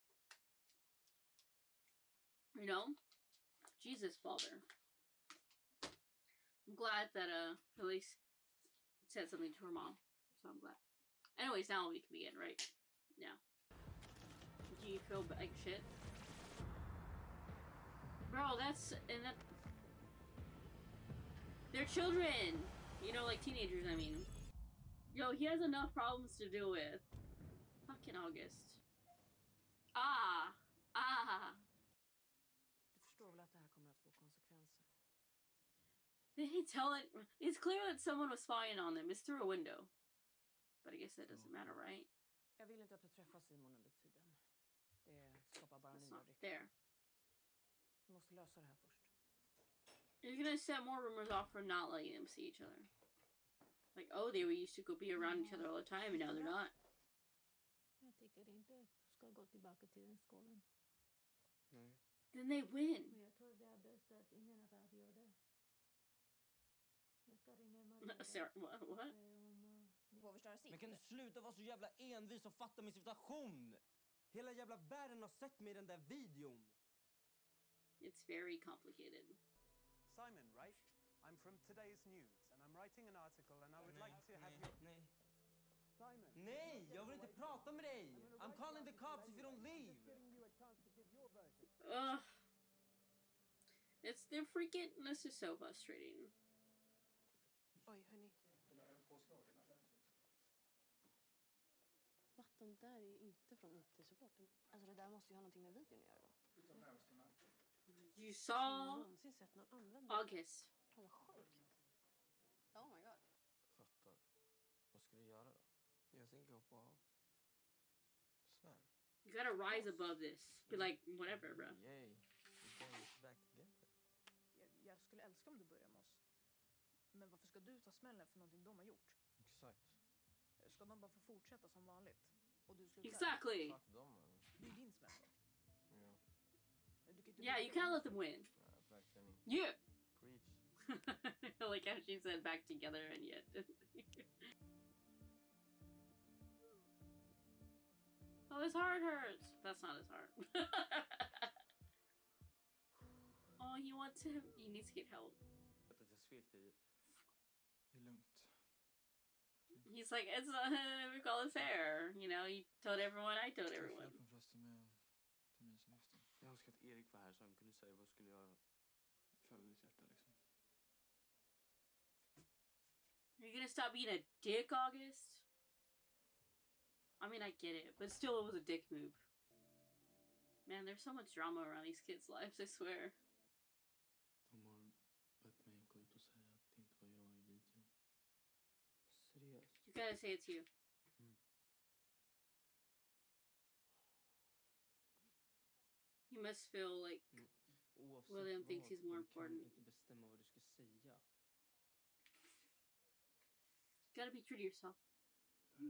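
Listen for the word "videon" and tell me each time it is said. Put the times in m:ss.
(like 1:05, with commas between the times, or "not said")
1:15, 1:45, 3:07.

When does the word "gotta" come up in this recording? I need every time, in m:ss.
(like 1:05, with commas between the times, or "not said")
1:59, 3:09, 3:24.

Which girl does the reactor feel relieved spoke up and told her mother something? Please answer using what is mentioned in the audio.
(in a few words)
Elise.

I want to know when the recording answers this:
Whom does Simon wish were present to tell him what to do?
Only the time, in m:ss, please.
2:46.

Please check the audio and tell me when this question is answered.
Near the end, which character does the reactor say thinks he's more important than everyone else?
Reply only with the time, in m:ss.
3:18.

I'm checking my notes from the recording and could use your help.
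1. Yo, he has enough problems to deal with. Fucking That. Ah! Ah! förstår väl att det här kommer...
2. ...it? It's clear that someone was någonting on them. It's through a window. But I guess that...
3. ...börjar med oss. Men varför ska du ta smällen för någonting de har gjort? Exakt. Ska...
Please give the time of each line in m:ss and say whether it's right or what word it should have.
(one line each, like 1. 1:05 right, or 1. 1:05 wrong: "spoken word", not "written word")
1. 0:25 wrong: "August", not "That"
2. 0:36 wrong: "spying", not "någonting"
3. 2:05 right.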